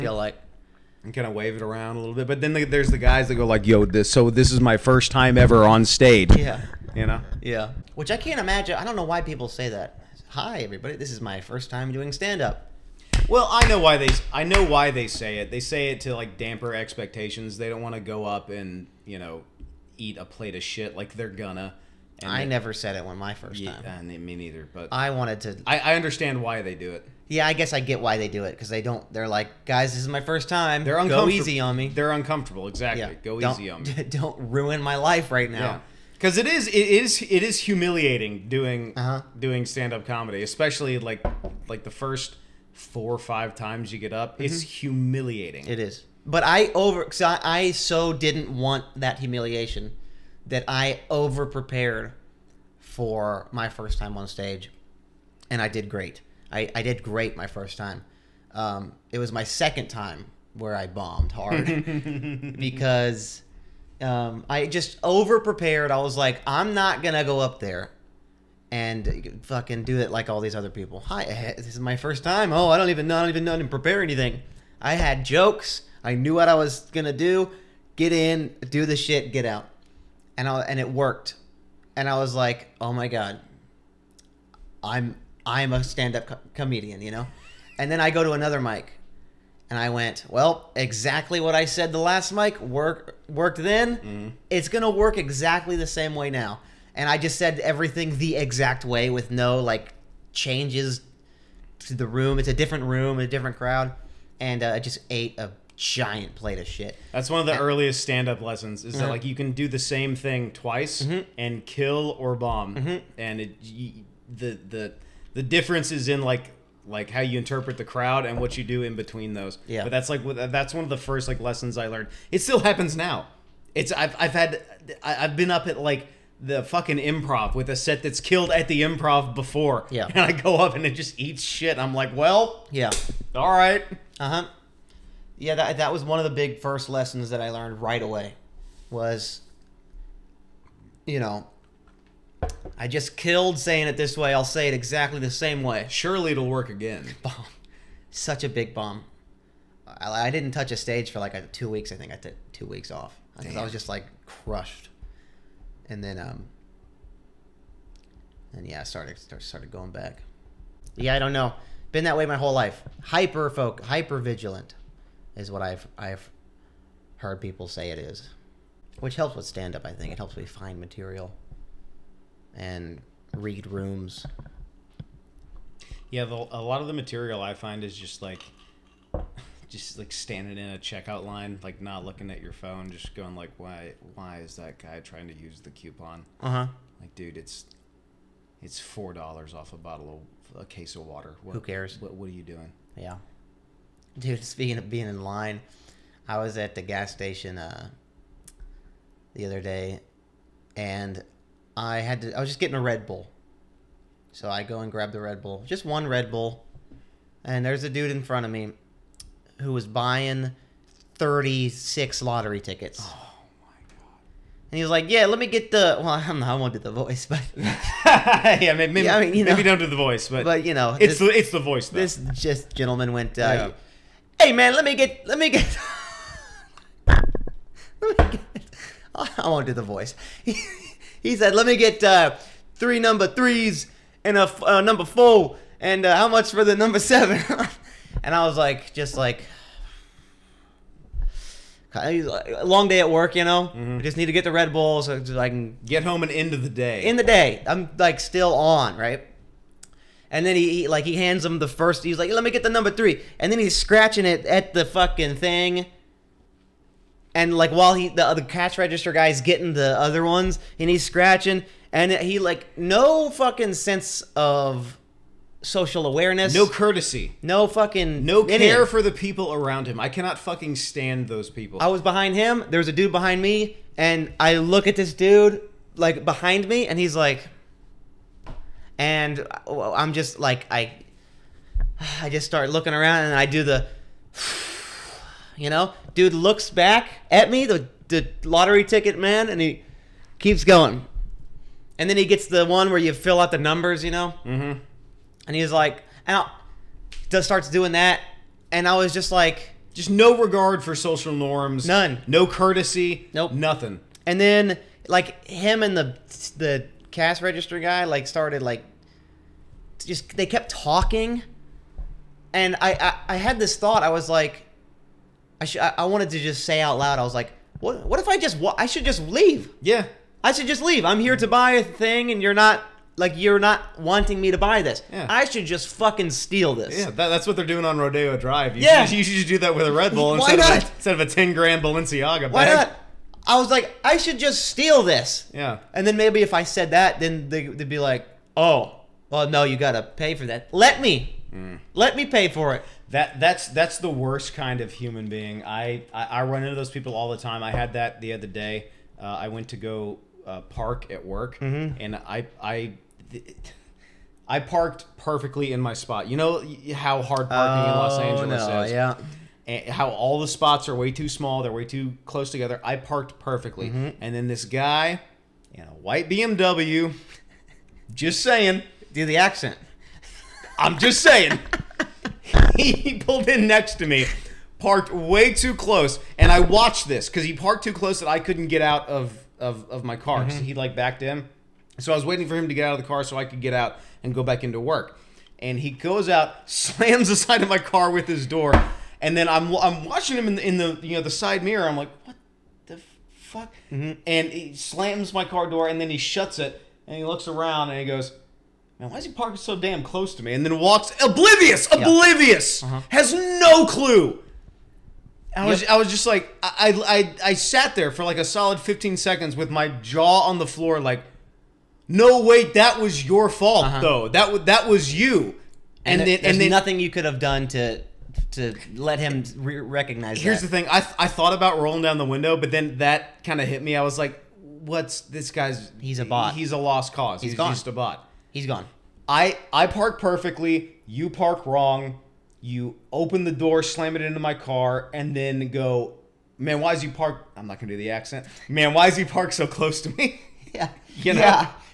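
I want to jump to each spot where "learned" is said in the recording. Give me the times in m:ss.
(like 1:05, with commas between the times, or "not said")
2:01, 2:17.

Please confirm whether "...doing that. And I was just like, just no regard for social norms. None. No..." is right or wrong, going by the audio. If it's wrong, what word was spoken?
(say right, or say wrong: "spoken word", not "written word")
right.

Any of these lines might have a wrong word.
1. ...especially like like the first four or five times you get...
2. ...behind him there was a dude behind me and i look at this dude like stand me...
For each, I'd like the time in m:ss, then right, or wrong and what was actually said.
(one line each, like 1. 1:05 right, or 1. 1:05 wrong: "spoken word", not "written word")
1. 0:40 right
2. 4:32 wrong: "behind", not "stand".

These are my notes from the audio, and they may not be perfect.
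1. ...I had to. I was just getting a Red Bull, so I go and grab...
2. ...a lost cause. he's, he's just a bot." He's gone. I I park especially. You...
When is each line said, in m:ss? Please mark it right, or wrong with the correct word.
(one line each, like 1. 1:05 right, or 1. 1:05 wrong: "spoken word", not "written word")
1. 3:21 right
2. 7:06 wrong: "perfectly", not "especially".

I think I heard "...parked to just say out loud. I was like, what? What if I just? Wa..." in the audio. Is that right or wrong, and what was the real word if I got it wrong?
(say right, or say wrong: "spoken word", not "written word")
wrong: "wanted", not "parked".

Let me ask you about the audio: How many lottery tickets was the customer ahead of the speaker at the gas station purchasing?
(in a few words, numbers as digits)
36.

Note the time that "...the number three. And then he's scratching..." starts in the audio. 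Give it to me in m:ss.
4:12.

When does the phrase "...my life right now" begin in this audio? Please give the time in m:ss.
0:34.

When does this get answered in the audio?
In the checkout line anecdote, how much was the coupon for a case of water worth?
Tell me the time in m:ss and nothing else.
3:08.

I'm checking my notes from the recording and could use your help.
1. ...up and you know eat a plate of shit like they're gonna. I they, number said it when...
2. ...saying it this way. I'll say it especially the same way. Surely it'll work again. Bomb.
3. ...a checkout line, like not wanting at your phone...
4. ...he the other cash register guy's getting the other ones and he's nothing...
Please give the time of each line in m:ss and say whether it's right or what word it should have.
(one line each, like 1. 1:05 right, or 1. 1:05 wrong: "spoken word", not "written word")
1. 0:18 wrong: "never", not "number"
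2. 2:23 wrong: "exactly", not "especially"
3. 3:00 wrong: "looking", not "wanting"
4. 4:17 wrong: "scratching", not "nothing".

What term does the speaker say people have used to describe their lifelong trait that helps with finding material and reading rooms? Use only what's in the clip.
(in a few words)
Hyper vigilant.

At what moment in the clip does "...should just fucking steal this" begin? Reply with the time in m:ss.
5:25.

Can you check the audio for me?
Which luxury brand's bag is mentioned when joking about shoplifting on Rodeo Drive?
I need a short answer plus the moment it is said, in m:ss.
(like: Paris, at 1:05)
Balenciaga, at 5:31.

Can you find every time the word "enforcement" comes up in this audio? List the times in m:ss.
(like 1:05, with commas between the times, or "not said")
not said.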